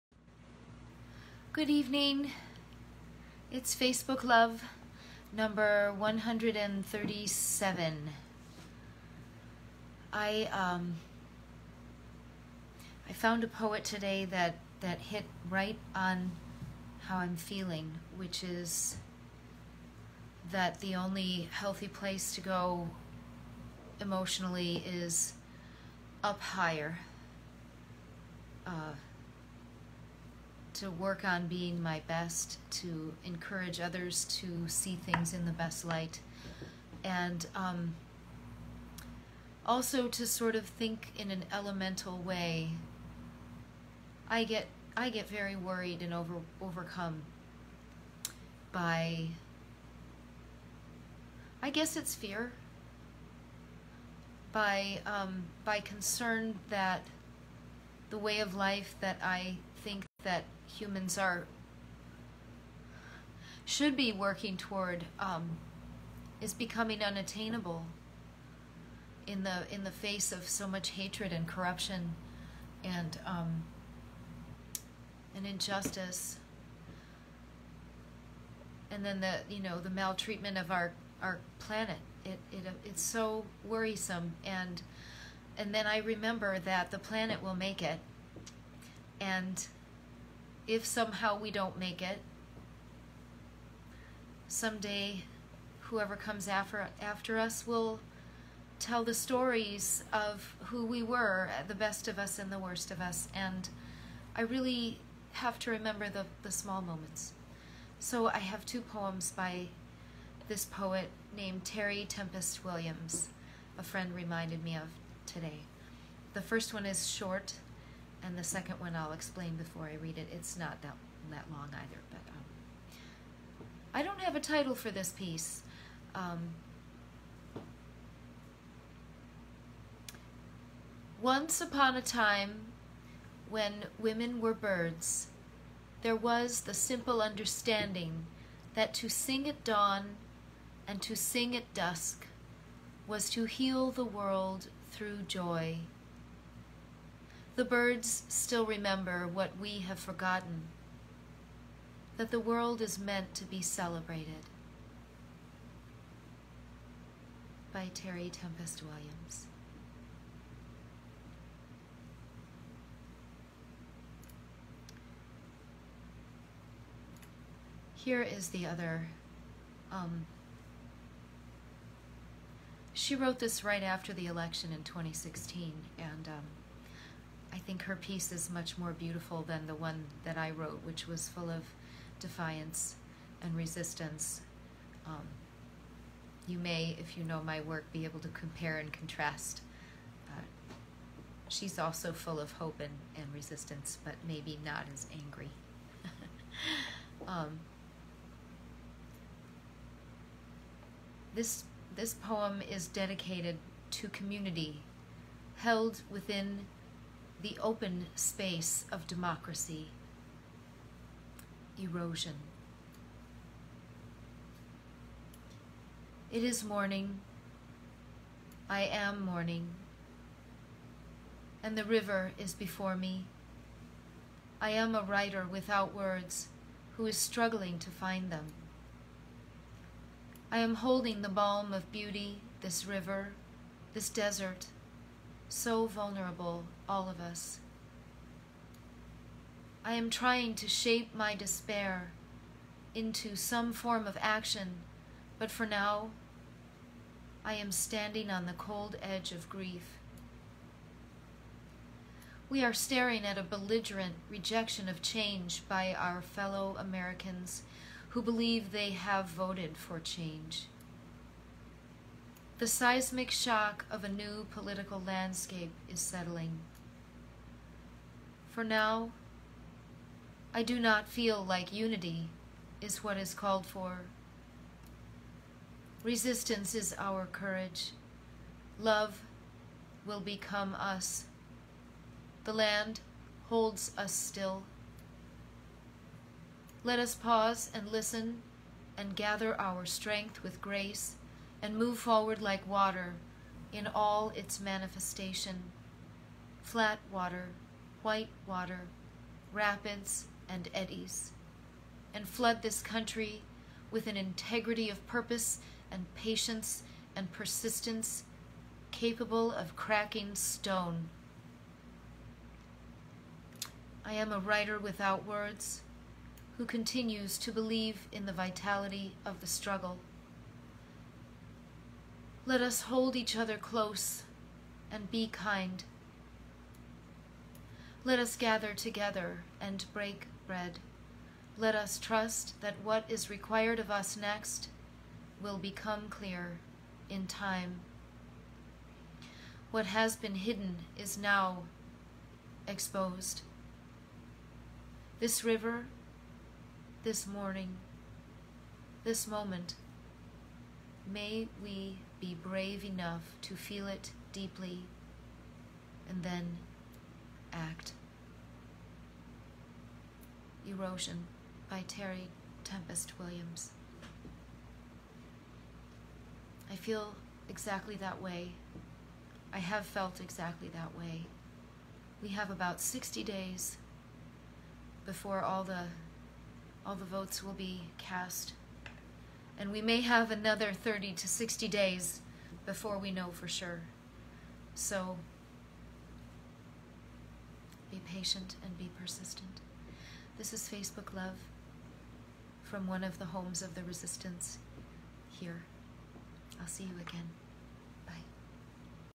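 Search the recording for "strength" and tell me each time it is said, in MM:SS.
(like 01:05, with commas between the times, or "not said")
04:49.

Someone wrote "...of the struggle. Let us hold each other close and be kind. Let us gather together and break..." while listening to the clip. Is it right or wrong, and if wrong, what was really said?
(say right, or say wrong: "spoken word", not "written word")
right.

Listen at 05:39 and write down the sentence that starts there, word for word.
What has been hidden is now exposed.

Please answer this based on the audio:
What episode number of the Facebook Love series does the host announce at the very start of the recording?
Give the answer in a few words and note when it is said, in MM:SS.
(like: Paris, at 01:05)
137, at 00:05.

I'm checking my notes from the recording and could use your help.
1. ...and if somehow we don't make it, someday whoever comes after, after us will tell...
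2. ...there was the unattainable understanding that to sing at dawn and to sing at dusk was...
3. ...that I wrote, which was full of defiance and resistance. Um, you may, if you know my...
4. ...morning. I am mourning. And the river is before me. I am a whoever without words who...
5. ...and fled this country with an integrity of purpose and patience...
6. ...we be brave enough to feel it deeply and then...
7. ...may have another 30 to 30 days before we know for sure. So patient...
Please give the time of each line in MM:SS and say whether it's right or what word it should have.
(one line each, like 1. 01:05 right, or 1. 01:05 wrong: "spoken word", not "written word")
1. 01:29 right
2. 02:16 wrong: "simple", not "unattainable"
3. 03:00 right
4. 03:36 wrong: "writer", not "whoever"
5. 05:02 right
6. 05:51 right
7. 06:19 wrong: "60", not "30".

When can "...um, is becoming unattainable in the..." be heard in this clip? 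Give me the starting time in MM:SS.
01:05.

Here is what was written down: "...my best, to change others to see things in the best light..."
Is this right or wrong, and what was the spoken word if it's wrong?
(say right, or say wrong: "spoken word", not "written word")
wrong: "encourage", not "change".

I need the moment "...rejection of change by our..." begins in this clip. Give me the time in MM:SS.
04:14.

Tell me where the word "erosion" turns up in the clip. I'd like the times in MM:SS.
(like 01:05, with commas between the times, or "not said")
03:31, 06:00.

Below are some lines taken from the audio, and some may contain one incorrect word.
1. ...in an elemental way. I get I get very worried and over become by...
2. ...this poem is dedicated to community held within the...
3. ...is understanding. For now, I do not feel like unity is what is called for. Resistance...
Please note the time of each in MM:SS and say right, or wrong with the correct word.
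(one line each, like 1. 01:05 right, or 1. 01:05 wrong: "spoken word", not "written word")
1. 00:41 wrong: "overcome", not "become"
2. 03:21 right
3. 04:25 wrong: "settling", not "understanding".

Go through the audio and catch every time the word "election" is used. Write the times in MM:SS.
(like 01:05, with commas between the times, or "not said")
02:54.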